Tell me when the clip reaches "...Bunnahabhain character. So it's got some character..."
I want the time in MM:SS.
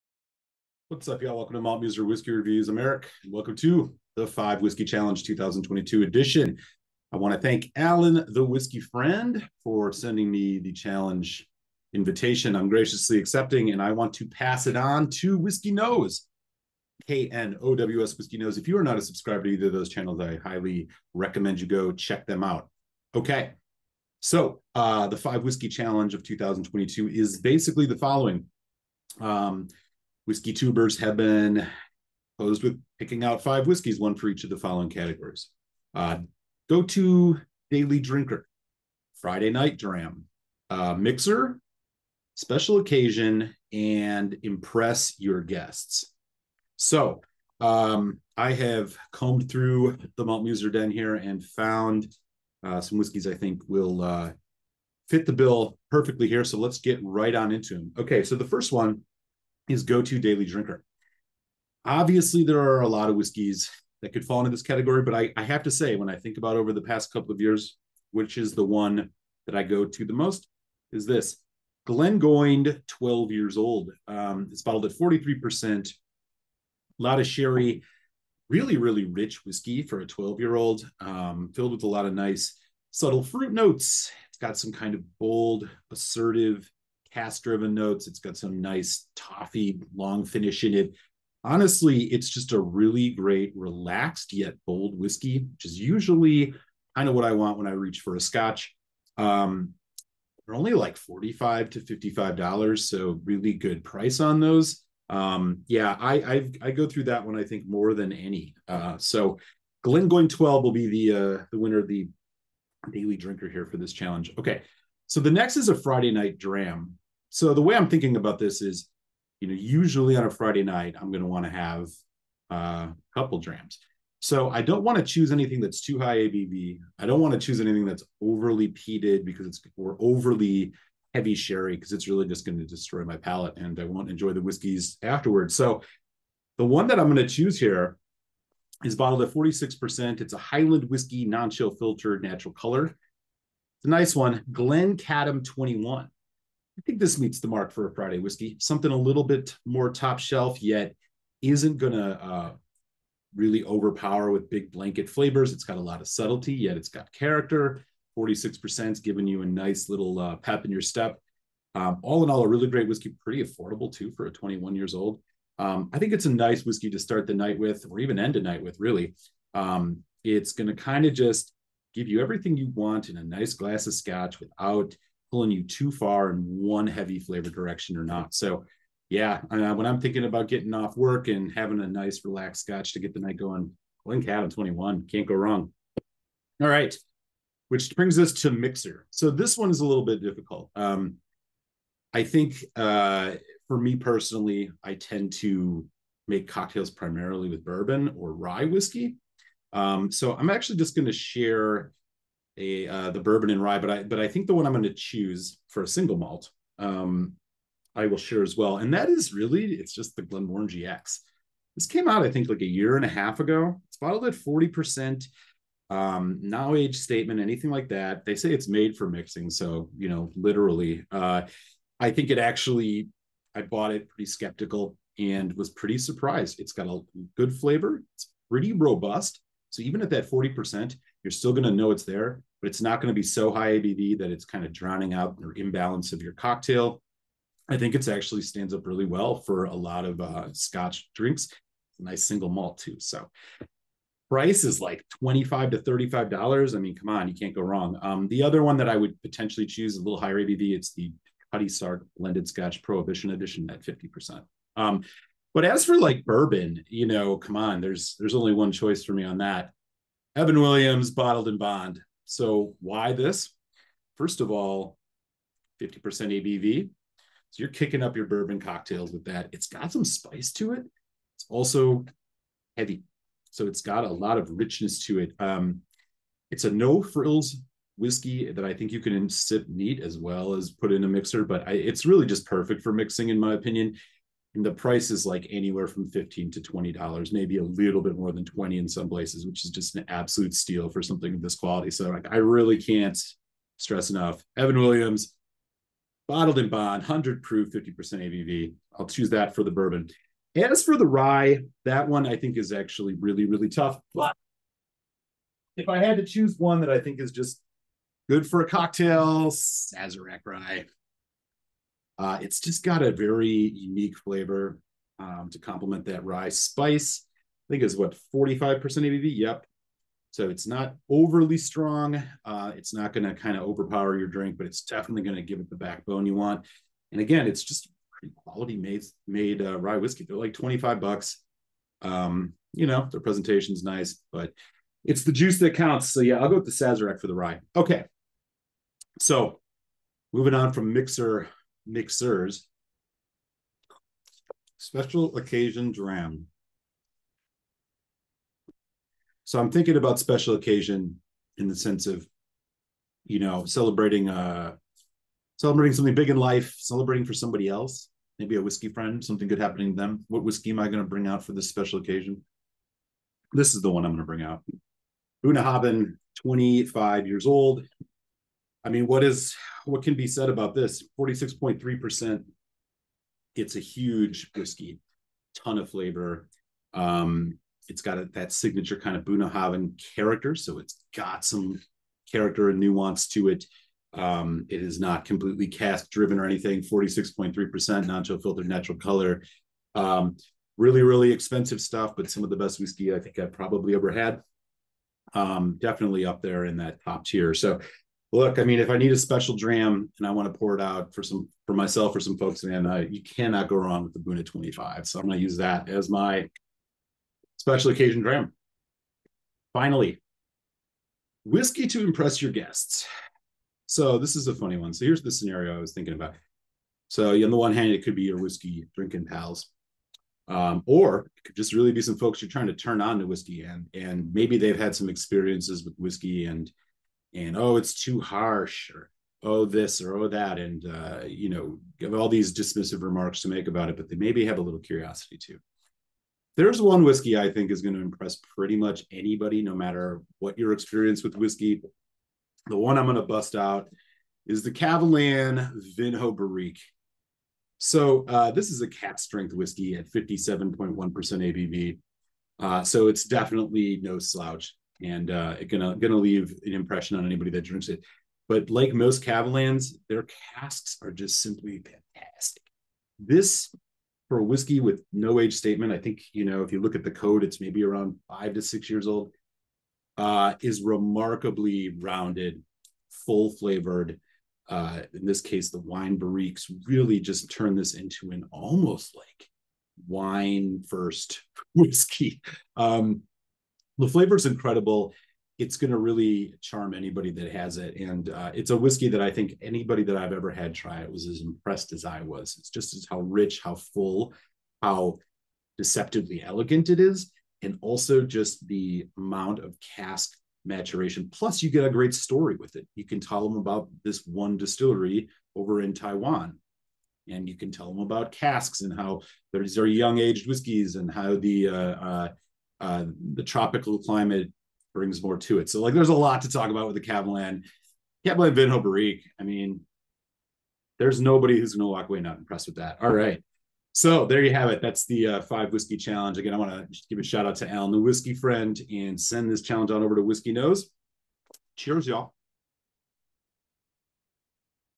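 06:19.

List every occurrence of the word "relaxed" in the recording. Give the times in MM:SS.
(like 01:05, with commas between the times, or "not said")
01:33, 03:02.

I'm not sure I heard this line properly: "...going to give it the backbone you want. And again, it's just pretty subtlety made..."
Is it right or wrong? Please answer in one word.
wrong.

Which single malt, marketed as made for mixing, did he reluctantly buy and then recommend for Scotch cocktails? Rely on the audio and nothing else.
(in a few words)
Glenmorangie X.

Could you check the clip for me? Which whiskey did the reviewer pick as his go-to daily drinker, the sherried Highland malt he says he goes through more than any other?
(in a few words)
Glengoyne 12.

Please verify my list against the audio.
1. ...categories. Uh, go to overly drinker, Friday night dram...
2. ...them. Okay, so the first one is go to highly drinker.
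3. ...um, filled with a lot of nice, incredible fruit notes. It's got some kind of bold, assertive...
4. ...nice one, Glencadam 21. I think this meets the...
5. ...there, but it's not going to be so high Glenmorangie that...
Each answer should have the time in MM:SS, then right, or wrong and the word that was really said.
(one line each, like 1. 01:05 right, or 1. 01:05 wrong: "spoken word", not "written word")
1. 00:34 wrong: "daily", not "overly"
2. 00:57 wrong: "daily", not "highly"
3. 01:20 wrong: "subtle", not "incredible"
4. 02:23 right
5. 03:52 wrong: "ABV", not "Glenmorangie".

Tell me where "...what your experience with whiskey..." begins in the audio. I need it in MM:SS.
07:20.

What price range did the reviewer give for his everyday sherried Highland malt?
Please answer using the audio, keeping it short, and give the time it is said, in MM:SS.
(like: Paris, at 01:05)
$45 to $55, at 01:40.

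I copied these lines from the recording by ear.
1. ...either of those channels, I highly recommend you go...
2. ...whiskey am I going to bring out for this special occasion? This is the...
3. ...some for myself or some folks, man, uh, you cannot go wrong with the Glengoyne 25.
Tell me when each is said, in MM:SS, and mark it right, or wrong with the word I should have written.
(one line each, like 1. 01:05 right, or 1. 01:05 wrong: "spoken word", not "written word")
1. 00:19 right
2. 06:00 right
3. 06:41 wrong: "Buna", not "Glengoyne".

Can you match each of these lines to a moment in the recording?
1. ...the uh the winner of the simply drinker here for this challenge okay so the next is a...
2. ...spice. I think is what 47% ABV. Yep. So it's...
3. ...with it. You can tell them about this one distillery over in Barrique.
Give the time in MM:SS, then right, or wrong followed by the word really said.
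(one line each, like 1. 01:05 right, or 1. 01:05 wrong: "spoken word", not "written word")
1. 01:51 wrong: "daily", not "simply"
2. 05:16 wrong: "45", not "47"
3. 08:22 wrong: "Taiwan", not "Barrique".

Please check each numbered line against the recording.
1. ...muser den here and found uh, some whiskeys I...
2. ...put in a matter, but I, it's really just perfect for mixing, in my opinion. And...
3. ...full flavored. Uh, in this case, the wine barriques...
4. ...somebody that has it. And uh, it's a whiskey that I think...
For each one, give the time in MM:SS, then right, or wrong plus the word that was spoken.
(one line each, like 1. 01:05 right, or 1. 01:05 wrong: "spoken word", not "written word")
1. 00:50 right
2. 04:40 wrong: "mixer", not "matter"
3. 07:53 right
4. 08:06 wrong: "anybody", not "somebody".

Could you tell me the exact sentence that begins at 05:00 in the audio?
As for the rye, that one I think is actually really, really tough.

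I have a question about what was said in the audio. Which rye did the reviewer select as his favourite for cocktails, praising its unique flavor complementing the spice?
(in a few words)
Sazerac rye.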